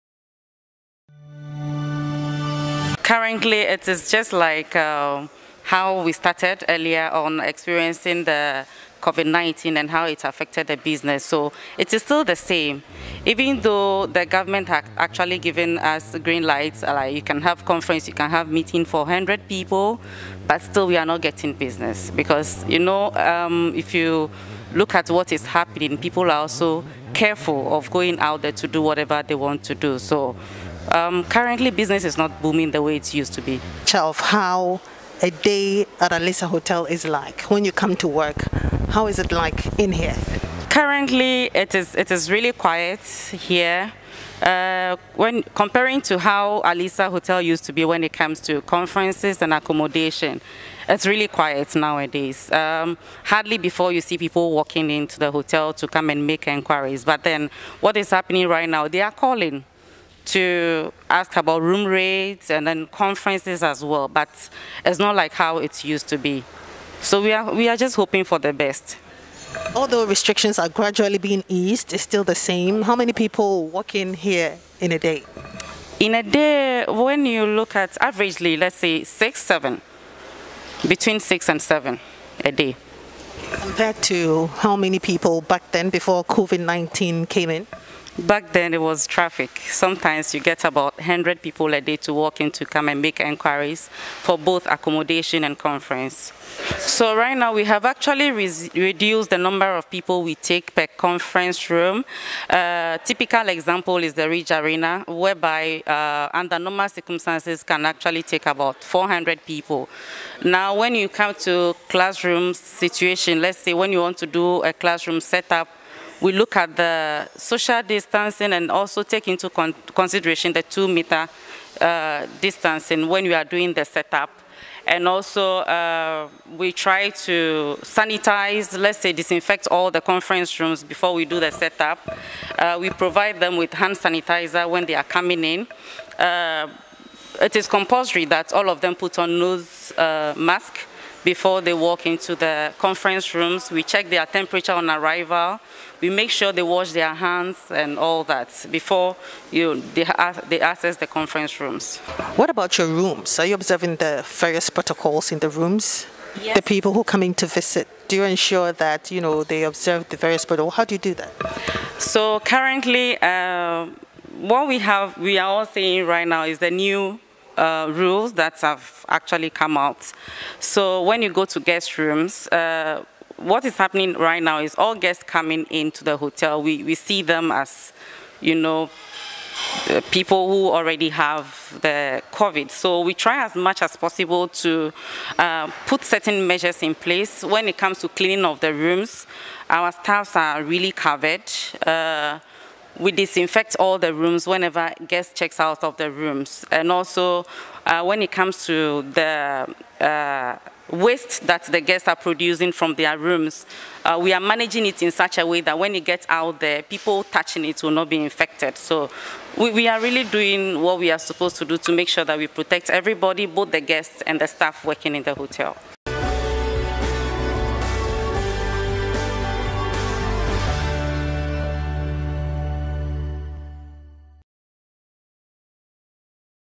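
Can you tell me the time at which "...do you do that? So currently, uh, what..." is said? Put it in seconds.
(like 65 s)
160 s.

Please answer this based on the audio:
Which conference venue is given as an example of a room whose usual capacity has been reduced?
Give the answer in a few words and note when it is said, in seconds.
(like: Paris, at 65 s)
Ridge Arena, at 104 s.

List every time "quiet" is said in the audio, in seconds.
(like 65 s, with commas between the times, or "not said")
42 s, 51 s.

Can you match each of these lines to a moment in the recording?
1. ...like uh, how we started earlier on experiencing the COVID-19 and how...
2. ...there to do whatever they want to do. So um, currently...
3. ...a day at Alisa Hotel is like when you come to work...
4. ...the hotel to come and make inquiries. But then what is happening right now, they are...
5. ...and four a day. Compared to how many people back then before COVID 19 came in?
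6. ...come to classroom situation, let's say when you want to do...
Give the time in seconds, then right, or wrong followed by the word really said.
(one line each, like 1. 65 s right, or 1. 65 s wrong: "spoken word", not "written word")
1. 4 s right
2. 28 s right
3. 35 s right
4. 55 s right
5. 81 s wrong: "seven", not "four"
6. 111 s right.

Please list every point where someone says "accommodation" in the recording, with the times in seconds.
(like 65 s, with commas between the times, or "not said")
49 s, 94 s.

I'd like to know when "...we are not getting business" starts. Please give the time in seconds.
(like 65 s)
20 s.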